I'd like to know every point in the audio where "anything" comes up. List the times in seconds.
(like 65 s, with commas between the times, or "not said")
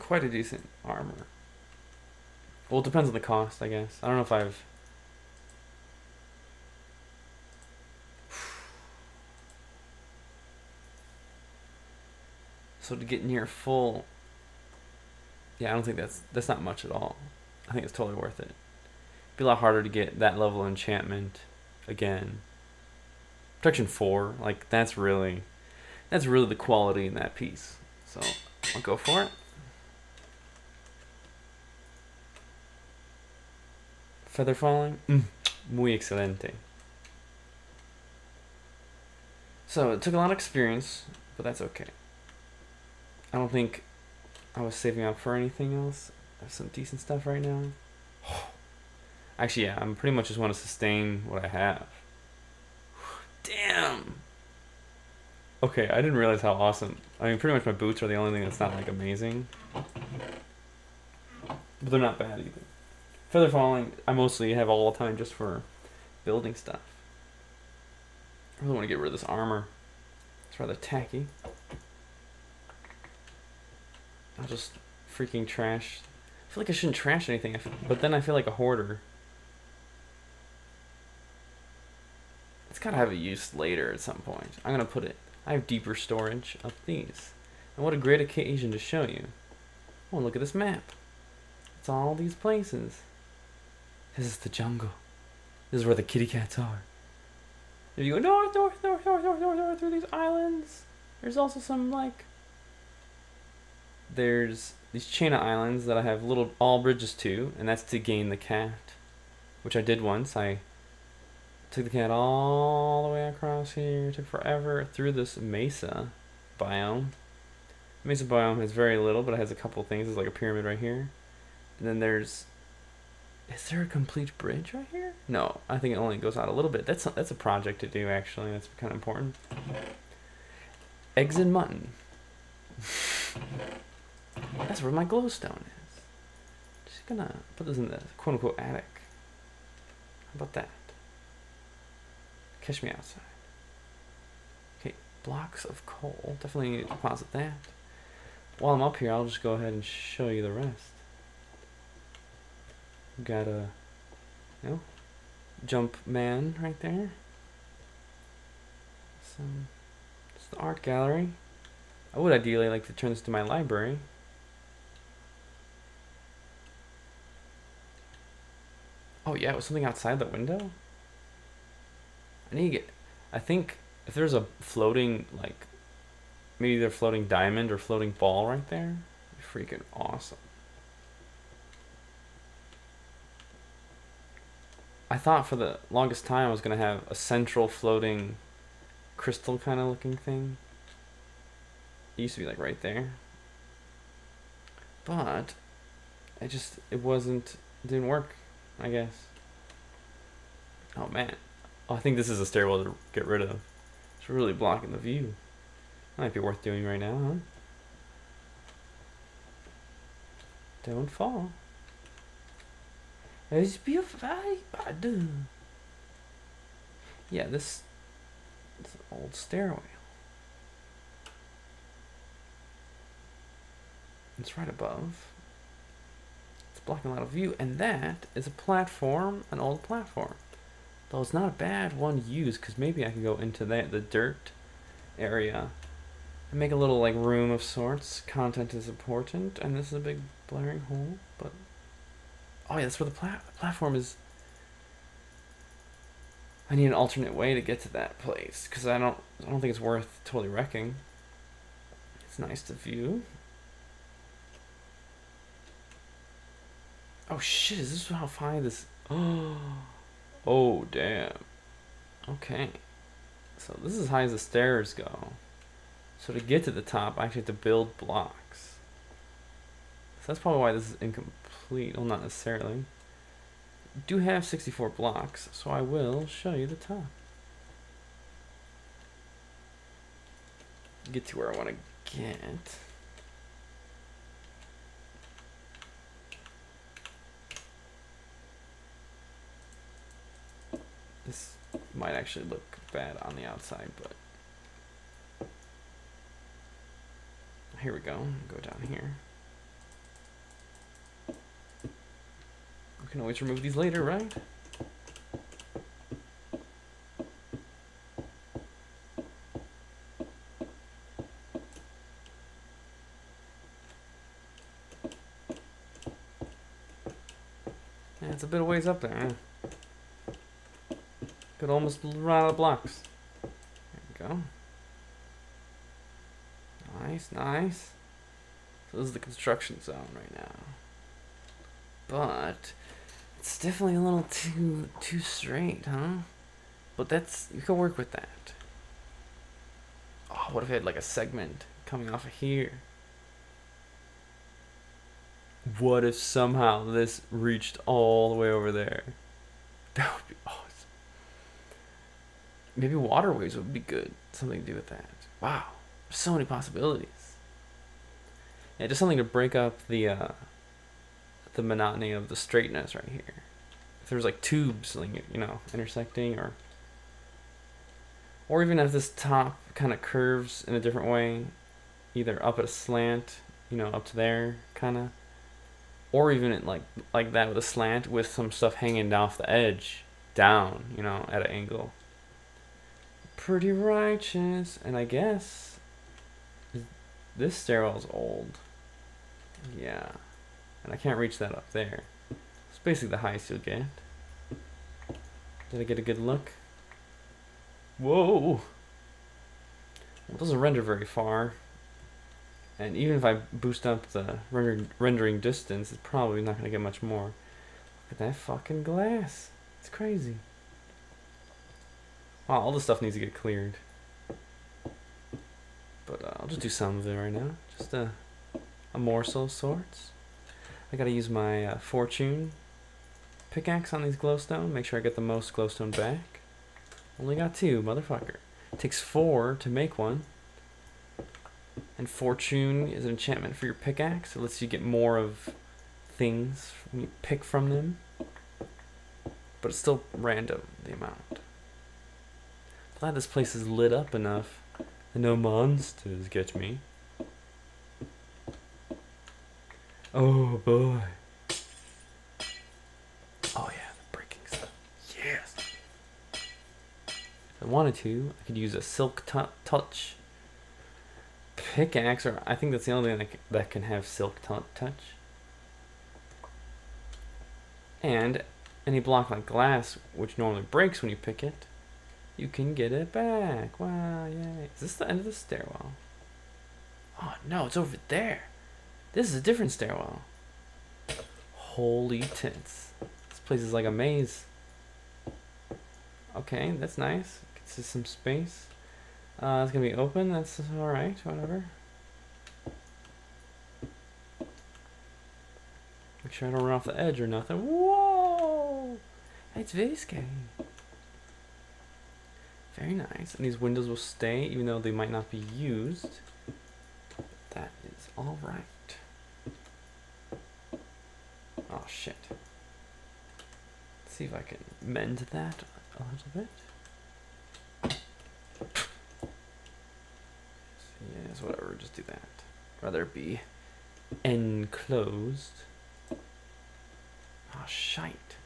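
45 s, 77 s.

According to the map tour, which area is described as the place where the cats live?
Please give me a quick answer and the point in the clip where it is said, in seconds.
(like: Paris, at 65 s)
The jungle, at 94 s.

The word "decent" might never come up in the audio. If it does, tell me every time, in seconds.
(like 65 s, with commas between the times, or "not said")
0 s, 46 s.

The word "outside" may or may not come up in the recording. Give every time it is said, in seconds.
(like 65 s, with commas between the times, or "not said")
142 s, 169 s, 293 s.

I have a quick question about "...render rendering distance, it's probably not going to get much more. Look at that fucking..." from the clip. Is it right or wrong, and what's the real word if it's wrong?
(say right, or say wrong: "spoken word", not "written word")
right.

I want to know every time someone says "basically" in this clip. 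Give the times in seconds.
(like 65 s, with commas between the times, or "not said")
392 s.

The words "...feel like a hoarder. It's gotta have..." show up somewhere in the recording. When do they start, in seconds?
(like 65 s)
78 s.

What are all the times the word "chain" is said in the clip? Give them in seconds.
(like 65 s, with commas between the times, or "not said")
105 s.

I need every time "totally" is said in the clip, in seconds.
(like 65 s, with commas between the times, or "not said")
17 s, 250 s.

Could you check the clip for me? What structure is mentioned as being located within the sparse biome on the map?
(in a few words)
A pyramid.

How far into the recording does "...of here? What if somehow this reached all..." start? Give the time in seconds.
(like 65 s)
342 s.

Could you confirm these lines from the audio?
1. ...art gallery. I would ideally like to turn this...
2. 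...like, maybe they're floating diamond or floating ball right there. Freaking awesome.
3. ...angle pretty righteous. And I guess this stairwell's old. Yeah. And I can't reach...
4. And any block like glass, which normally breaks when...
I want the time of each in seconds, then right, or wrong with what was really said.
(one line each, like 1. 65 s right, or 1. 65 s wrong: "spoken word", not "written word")
1. 160 s right
2. 175 s right
3. 381 s right
4. 468 s right.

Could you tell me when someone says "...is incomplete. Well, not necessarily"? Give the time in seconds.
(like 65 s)
270 s.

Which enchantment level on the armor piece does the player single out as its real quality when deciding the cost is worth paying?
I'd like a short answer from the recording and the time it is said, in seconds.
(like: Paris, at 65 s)
Protection 4, at 23 s.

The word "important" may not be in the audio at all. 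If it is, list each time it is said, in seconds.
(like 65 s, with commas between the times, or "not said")
128 s, 238 s.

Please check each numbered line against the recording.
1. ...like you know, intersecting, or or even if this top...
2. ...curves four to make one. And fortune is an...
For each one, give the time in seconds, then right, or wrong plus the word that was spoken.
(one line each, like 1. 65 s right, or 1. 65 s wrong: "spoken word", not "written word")
1. 364 s right
2. 428 s wrong: "takes", not "curves".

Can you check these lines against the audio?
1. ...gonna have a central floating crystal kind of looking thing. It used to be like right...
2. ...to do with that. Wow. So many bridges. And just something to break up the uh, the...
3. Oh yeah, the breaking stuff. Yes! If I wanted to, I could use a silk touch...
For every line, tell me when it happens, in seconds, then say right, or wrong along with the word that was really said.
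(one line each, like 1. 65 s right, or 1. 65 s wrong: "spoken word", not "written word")
1. 186 s right
2. 354 s wrong: "possibilities", not "bridges"
3. 453 s right.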